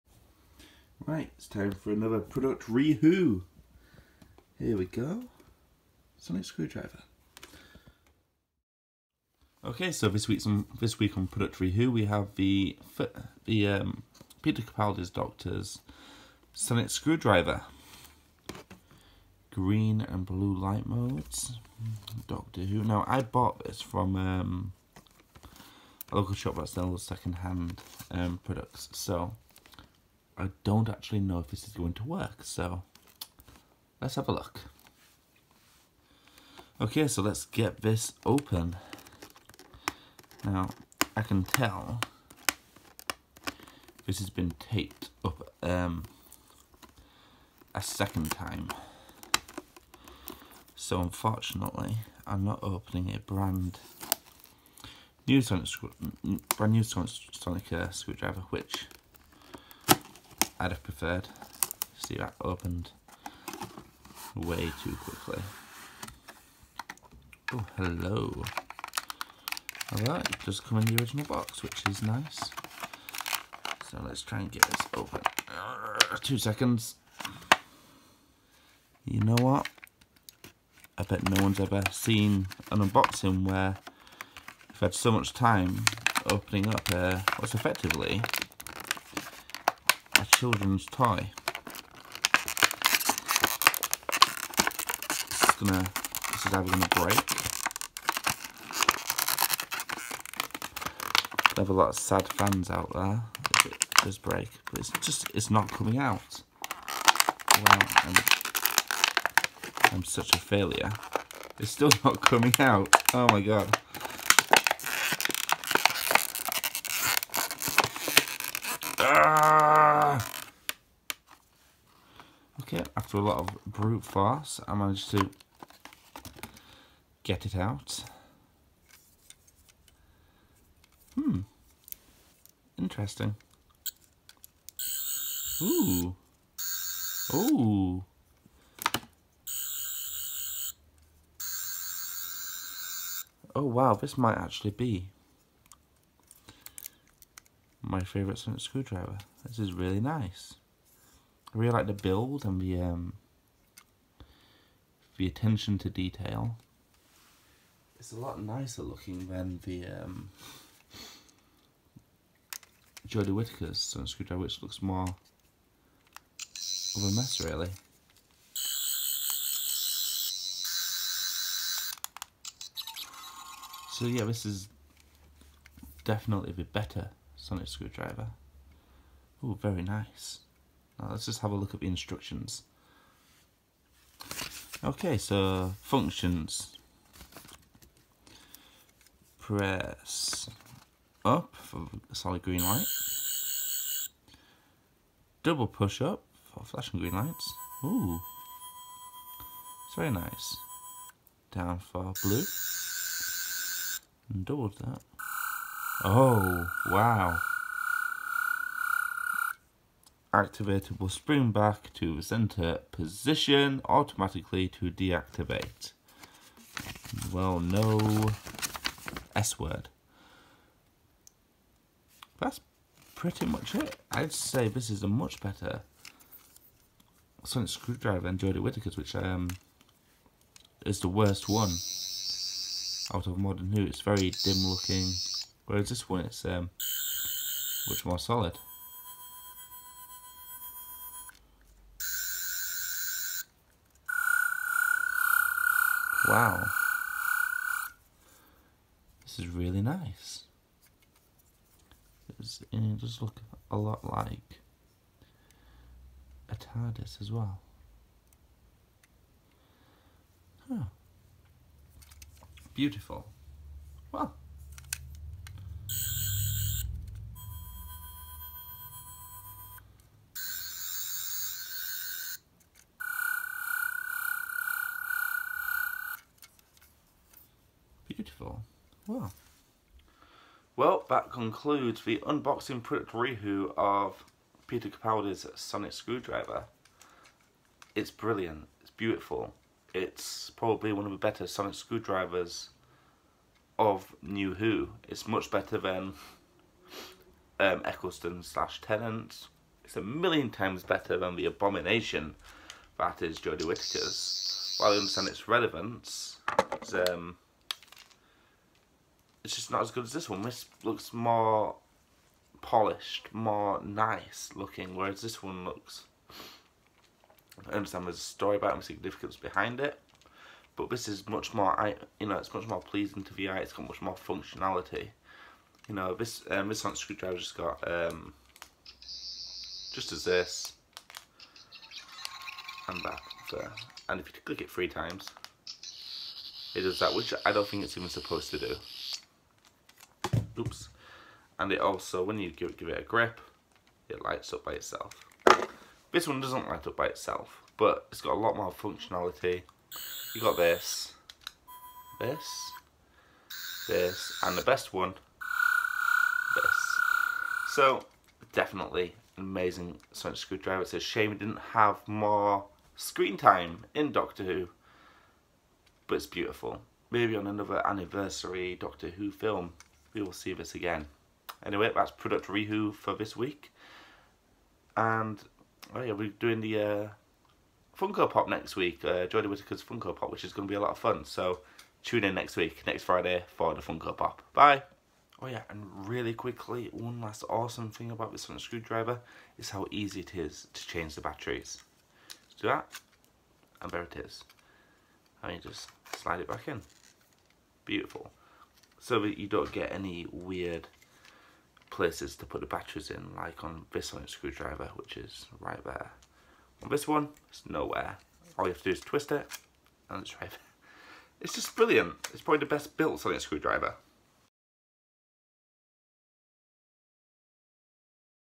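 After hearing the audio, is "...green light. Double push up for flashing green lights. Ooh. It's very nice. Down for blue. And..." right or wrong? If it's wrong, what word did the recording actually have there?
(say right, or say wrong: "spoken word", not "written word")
right.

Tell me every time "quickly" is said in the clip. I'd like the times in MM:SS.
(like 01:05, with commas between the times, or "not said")
01:04, 06:26.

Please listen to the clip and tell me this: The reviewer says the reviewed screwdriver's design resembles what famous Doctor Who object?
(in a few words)
TARDIS.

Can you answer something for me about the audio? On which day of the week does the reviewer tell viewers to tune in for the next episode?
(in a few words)
Friday.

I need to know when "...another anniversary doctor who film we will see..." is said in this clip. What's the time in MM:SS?
06:07.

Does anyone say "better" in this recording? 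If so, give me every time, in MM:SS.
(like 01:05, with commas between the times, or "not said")
02:56, 03:45, 04:51, 04:55, 05:00.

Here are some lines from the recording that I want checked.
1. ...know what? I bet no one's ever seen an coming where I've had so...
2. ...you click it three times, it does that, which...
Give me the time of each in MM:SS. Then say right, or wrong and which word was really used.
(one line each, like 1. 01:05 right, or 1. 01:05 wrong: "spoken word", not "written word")
1. 01:19 wrong: "unboxing", not "coming"
2. 05:34 right.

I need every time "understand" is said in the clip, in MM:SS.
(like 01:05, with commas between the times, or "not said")
05:04, 05:17.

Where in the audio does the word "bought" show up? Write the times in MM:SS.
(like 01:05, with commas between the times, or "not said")
00:23.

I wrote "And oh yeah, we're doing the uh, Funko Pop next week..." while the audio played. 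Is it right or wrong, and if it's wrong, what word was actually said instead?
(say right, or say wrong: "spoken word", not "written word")
right.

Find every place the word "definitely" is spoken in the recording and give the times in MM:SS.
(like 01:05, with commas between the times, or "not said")
02:56, 05:58.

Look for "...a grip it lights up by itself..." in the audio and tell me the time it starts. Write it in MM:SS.
05:42.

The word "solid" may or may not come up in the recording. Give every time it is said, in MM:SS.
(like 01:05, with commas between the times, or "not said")
03:12, 03:58.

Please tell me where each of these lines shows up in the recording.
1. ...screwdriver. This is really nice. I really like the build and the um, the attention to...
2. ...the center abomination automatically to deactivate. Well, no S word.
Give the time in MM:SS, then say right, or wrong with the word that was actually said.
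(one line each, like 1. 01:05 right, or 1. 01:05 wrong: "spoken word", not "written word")
1. 02:28 right
2. 03:32 wrong: "position", not "abomination".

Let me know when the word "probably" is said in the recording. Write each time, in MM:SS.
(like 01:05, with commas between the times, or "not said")
04:50, 06:52.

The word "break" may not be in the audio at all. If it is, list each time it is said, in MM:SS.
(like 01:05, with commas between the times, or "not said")
01:36, 01:44.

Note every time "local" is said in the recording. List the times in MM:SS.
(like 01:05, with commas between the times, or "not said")
00:26.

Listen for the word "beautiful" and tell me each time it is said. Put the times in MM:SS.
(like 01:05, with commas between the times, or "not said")
04:22, 04:38, 04:48, 06:06, 06:37.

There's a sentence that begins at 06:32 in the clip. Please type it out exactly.
Let's do that, and there it is.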